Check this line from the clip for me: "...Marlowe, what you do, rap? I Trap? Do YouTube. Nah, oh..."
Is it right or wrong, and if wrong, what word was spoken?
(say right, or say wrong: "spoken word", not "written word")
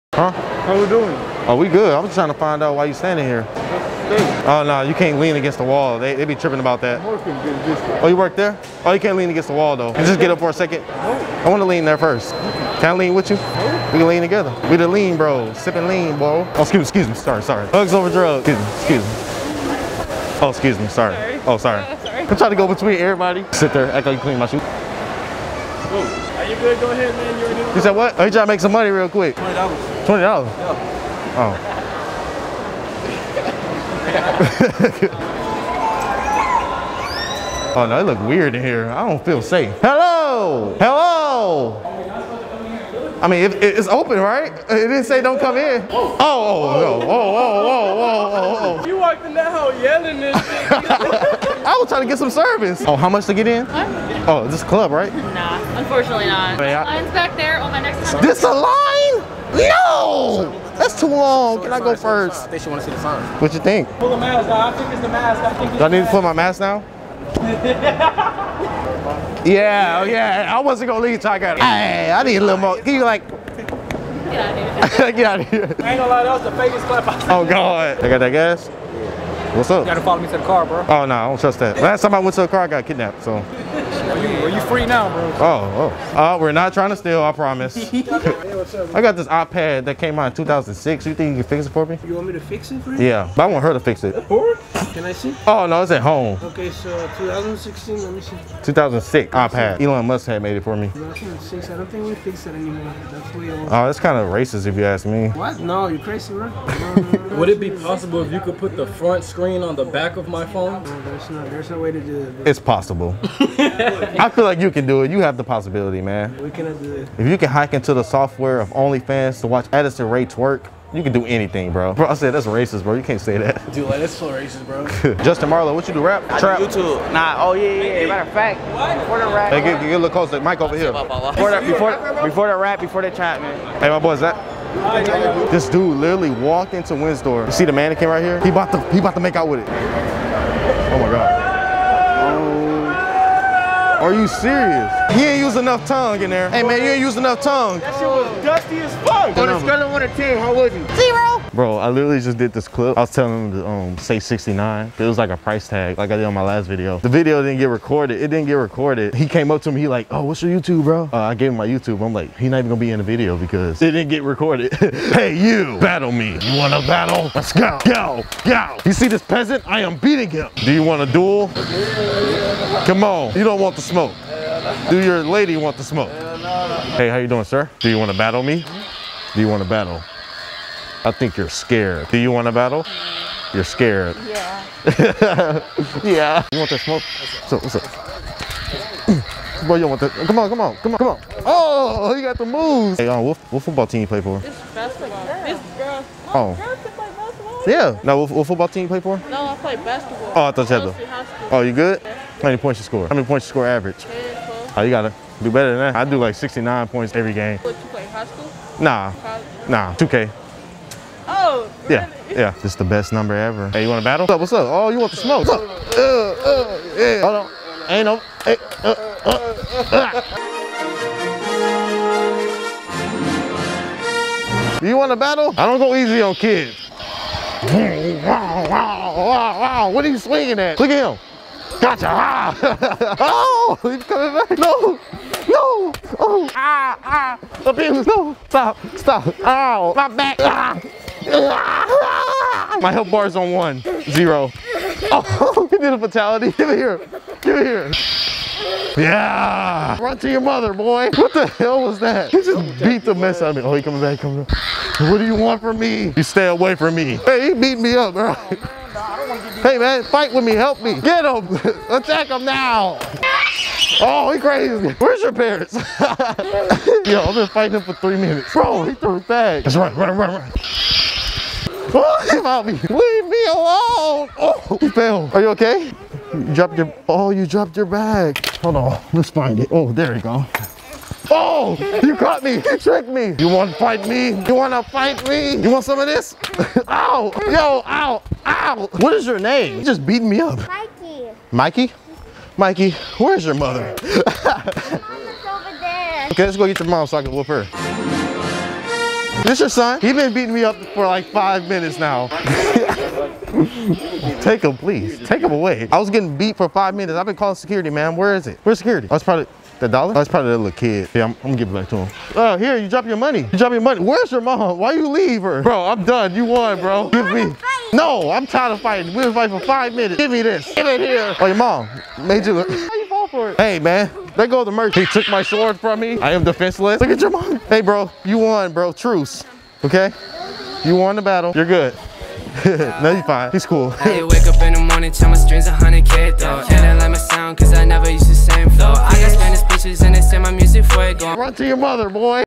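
right.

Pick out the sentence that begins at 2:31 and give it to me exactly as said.
Bro, I literally just did this clip.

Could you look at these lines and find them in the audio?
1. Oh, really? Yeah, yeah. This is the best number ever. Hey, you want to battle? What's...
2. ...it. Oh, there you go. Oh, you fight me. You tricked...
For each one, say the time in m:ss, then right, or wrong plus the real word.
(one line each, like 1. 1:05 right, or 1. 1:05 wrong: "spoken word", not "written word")
1. 3:31 right
2. 4:39 wrong: "caught", not "fight".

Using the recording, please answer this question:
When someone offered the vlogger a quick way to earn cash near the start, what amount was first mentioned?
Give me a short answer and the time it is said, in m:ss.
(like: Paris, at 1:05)
$20, at 0:29.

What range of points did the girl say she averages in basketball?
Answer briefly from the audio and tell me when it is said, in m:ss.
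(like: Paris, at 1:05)
10, 12, at 3:24.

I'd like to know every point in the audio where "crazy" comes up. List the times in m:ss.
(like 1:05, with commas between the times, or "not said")
1:45, 4:24.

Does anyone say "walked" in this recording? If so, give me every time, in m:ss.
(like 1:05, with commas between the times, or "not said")
0:48, 2:16.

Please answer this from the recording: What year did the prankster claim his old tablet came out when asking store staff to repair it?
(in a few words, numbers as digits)
2006.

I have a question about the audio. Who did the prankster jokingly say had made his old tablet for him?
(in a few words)
Elon Musk.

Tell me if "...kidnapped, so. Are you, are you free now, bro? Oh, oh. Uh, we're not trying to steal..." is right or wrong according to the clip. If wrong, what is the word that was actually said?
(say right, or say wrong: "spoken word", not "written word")
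right.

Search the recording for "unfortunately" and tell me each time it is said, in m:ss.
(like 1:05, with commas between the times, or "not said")
0:55.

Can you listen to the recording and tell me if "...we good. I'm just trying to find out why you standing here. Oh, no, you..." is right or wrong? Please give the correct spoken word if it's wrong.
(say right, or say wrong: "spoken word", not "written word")
right.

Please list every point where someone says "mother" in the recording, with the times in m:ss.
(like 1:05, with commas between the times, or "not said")
4:10, 4:53, 5:41.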